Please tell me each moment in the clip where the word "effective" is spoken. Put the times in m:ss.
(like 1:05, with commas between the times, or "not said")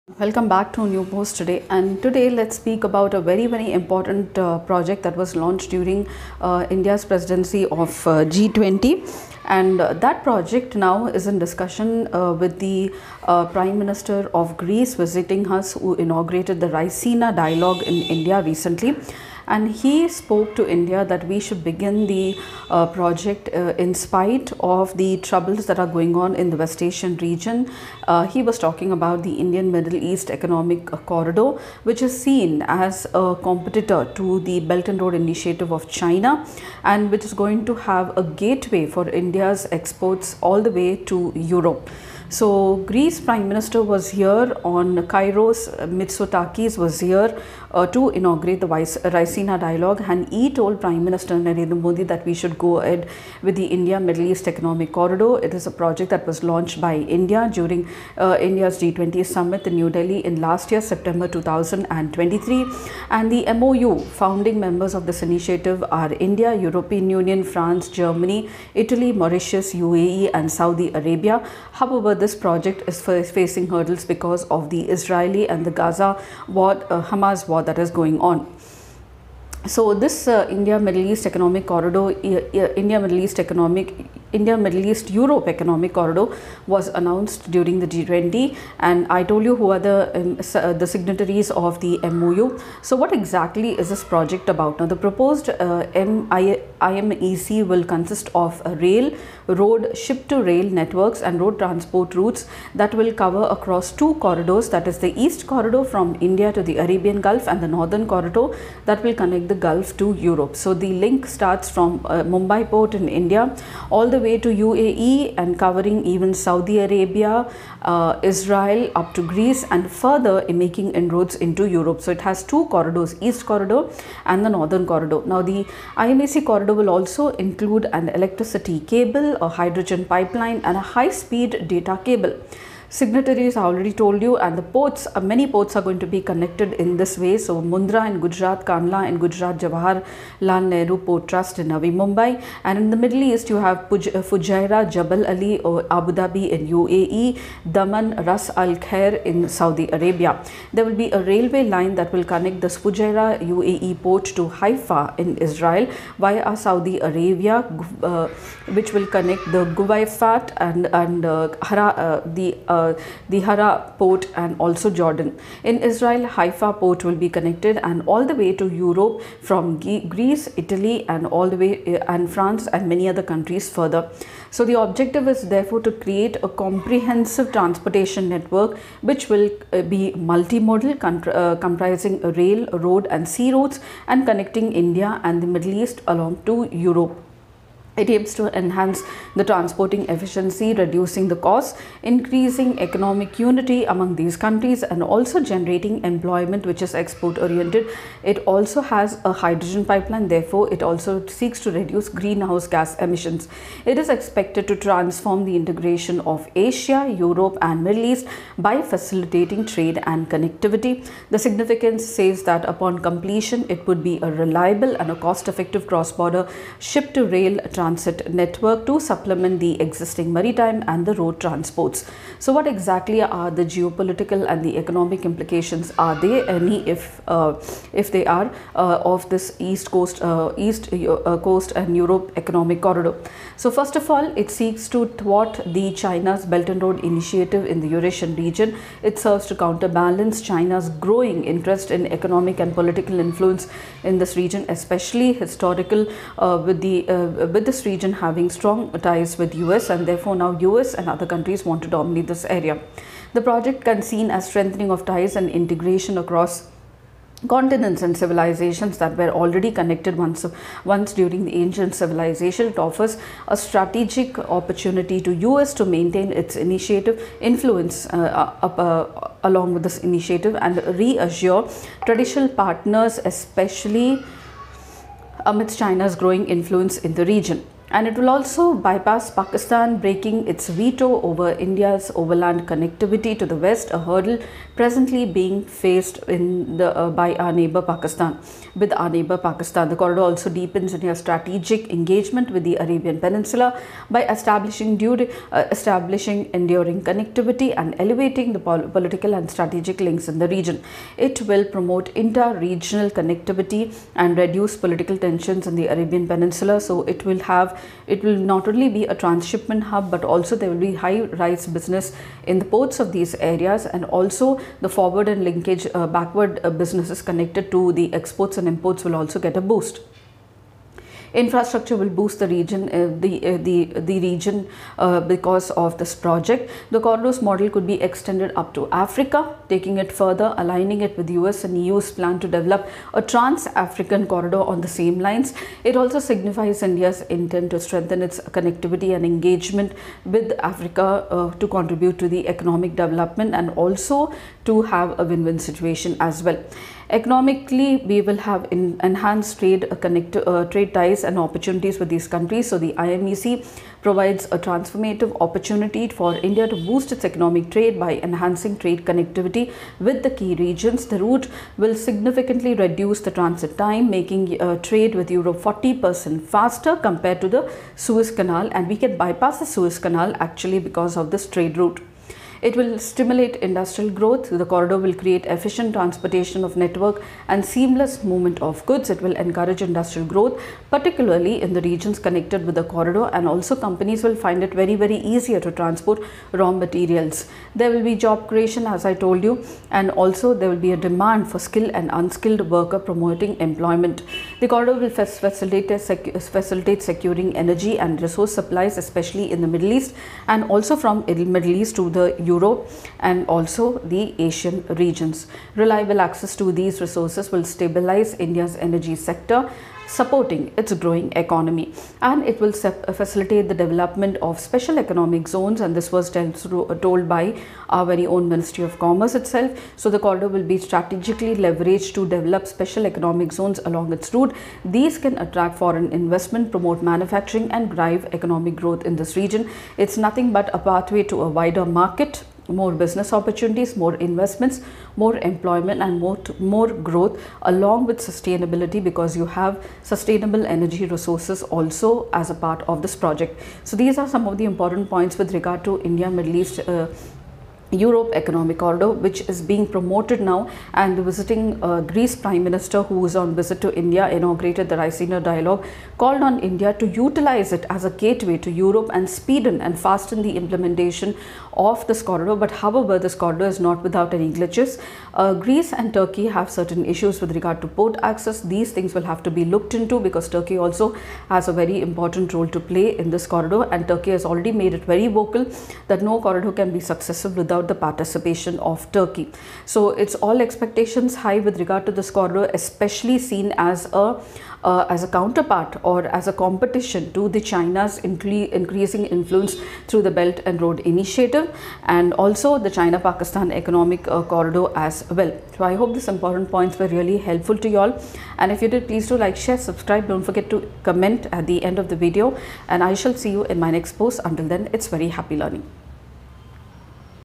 3:35.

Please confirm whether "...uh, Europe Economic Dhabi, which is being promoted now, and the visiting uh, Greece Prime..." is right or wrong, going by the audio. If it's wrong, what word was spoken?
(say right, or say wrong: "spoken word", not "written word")
wrong: "Order", not "Dhabi".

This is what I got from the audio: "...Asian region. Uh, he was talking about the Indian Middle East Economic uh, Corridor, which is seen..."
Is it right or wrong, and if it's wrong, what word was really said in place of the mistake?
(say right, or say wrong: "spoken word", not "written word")
right.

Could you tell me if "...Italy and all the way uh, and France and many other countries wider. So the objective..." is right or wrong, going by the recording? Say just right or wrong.
wrong.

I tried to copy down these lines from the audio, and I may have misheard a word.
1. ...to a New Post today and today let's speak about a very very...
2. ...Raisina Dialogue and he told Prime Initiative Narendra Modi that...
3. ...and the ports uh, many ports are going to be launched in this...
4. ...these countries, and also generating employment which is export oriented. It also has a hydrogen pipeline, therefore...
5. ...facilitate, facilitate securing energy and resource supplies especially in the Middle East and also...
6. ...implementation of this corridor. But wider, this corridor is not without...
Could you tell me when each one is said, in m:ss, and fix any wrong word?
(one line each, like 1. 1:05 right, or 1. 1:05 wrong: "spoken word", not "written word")
1. 0:00 right
2. 0:49 wrong: "Minister", not "Initiative"
3. 2:14 wrong: "connected", not "launched"
4. 3:14 right
5. 6:35 right
6. 7:40 wrong: "however", not "wider".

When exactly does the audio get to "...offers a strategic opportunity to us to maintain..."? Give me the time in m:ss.
4:22.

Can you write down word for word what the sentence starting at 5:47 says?
Economically, we will have enhanced trade uh, connect, uh, trade ties and opportunities with these countries.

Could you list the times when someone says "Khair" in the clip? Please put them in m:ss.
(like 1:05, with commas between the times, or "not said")
2:28.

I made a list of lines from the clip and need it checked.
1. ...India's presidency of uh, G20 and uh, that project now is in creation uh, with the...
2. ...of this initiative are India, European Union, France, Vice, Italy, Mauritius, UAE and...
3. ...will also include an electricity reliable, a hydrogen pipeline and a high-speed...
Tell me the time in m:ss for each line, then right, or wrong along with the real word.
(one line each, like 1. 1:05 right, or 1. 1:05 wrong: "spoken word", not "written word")
1. 0:06 wrong: "discussion", not "creation"
2. 1:04 wrong: "Germany", not "Vice"
3. 2:06 wrong: "cable", not "reliable".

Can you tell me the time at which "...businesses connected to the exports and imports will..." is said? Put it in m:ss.
5:16.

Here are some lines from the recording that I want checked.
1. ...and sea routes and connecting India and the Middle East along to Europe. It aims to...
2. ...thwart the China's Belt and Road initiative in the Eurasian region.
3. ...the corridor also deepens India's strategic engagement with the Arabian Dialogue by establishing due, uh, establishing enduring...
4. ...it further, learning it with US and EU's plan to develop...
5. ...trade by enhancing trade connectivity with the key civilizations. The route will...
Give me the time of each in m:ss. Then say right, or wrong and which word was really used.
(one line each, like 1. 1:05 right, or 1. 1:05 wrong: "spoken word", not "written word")
1. 3:03 right
2. 3:55 right
3. 4:49 wrong: "Peninsula", not "Dialogue"
4. 5:29 wrong: "aligning", not "learning"
5. 5:57 wrong: "regions", not "civilizations".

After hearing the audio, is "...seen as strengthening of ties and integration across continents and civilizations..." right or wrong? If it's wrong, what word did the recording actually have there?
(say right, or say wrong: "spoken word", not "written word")
right.